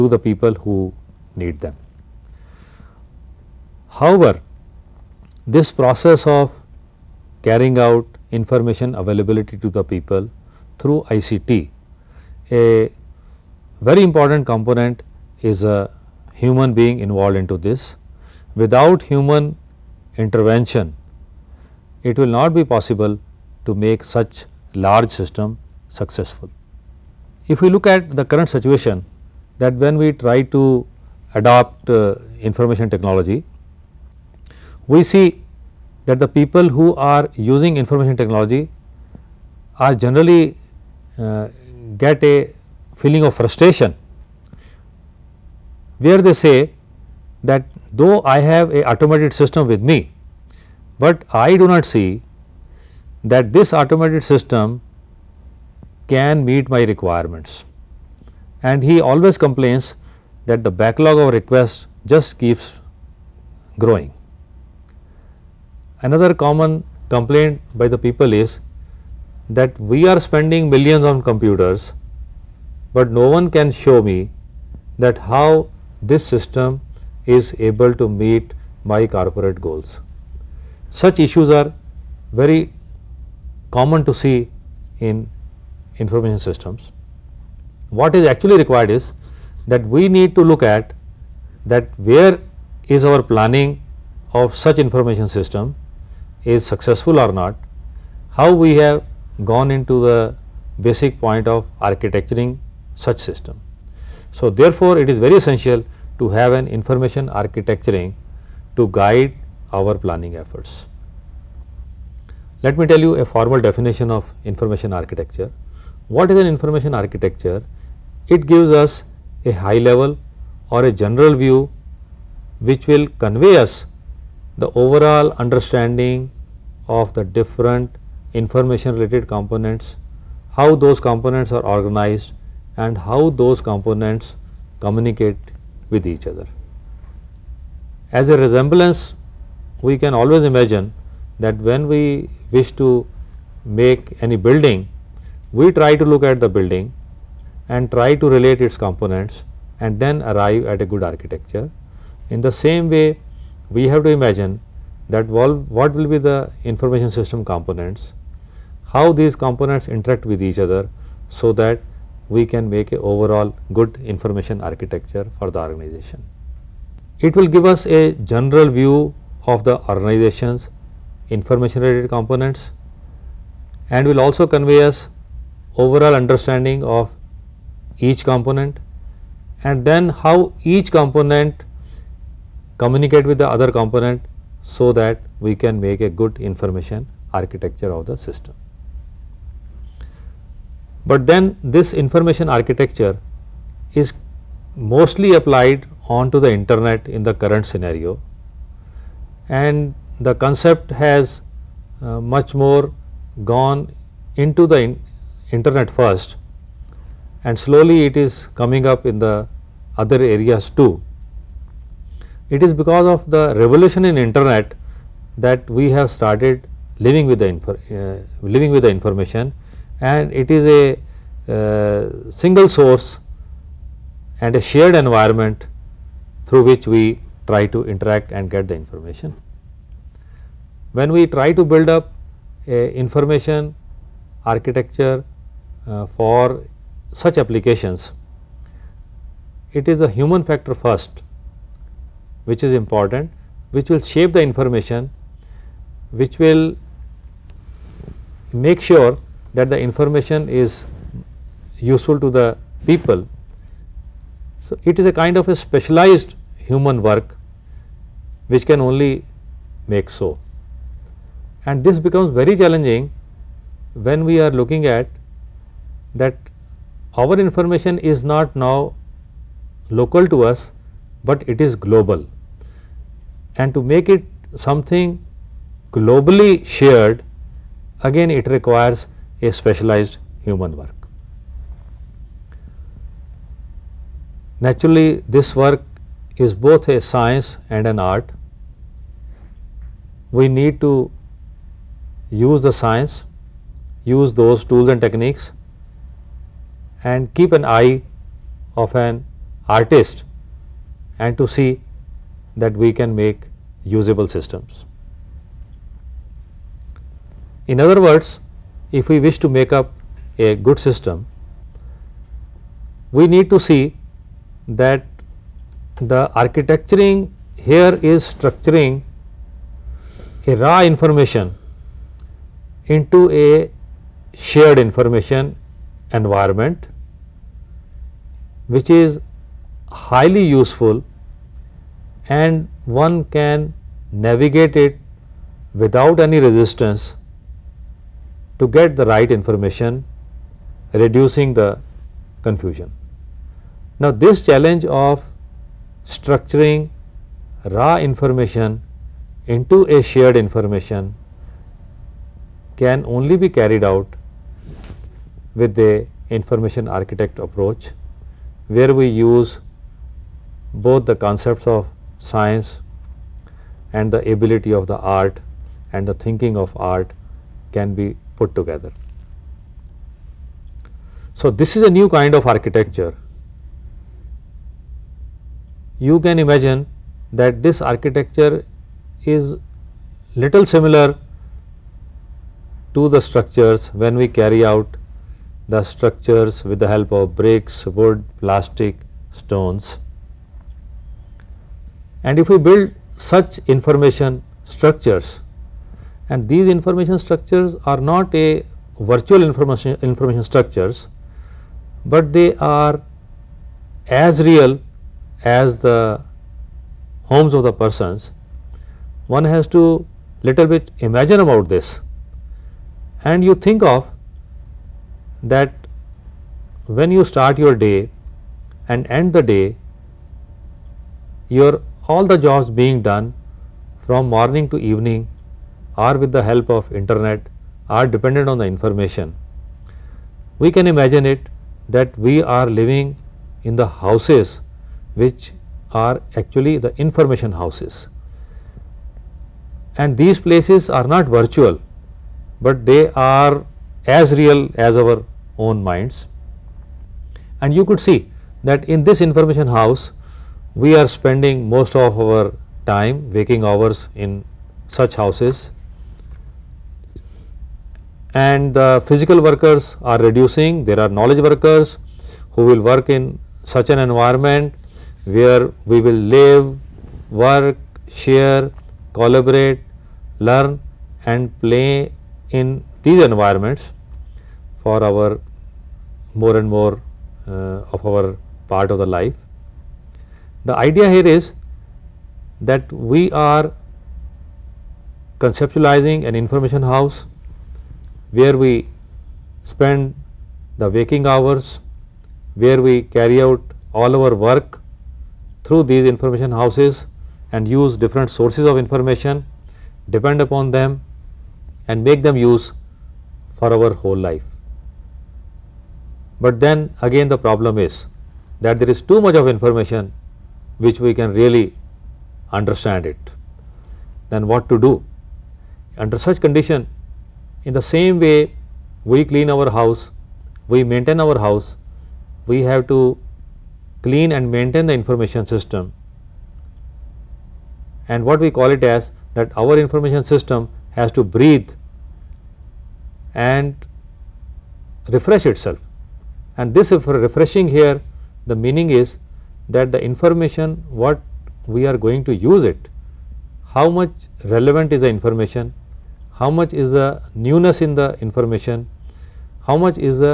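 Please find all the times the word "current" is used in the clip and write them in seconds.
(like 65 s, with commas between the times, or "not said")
28 s, 197 s.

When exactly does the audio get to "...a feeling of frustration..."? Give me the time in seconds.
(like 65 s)
42 s.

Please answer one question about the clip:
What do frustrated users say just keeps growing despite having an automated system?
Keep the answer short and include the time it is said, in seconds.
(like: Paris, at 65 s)
the backlog of requests, at 60 s.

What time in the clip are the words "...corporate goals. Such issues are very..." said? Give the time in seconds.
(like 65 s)
79 s.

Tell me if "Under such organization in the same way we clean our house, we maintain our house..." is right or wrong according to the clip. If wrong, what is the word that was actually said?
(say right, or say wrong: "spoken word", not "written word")
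wrong: "condition", not "organization".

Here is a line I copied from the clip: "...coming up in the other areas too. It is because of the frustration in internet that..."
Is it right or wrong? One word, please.
wrong.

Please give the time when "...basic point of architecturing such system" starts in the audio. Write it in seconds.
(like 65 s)
100 s.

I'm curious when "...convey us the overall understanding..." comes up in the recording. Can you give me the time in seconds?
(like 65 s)
123 s.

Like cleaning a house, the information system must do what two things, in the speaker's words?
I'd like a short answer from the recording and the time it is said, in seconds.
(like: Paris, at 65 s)
breathe and refresh, at 531 s.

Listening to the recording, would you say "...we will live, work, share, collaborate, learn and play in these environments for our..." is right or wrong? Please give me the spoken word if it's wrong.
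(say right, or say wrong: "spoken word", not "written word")
right.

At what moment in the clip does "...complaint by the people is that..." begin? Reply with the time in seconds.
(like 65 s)
67 s.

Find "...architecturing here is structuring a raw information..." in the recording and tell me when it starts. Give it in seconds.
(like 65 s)
316 s.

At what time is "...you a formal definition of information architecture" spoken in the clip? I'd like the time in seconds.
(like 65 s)
112 s.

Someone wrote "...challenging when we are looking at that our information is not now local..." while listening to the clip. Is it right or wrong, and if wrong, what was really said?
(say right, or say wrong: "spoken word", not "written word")
right.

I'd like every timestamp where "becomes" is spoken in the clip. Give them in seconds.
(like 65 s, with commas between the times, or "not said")
261 s.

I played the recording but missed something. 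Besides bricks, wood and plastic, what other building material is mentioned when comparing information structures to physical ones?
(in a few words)
stones.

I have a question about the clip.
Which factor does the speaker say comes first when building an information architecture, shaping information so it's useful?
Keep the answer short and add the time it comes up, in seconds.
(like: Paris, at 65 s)
the human factor, at 240 s.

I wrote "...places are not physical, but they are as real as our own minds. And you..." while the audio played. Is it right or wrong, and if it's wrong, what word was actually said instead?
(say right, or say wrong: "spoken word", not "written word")
wrong: "virtual", not "physical".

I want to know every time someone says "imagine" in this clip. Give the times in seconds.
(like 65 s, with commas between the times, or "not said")
140 s, 154 s, 376 s, 411 s, 430 s.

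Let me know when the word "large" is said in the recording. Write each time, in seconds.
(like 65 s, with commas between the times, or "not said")
24 s.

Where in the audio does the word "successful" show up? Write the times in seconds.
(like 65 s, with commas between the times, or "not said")
25 s, 96 s.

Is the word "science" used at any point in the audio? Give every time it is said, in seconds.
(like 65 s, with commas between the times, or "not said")
286 s, 292 s, 362 s.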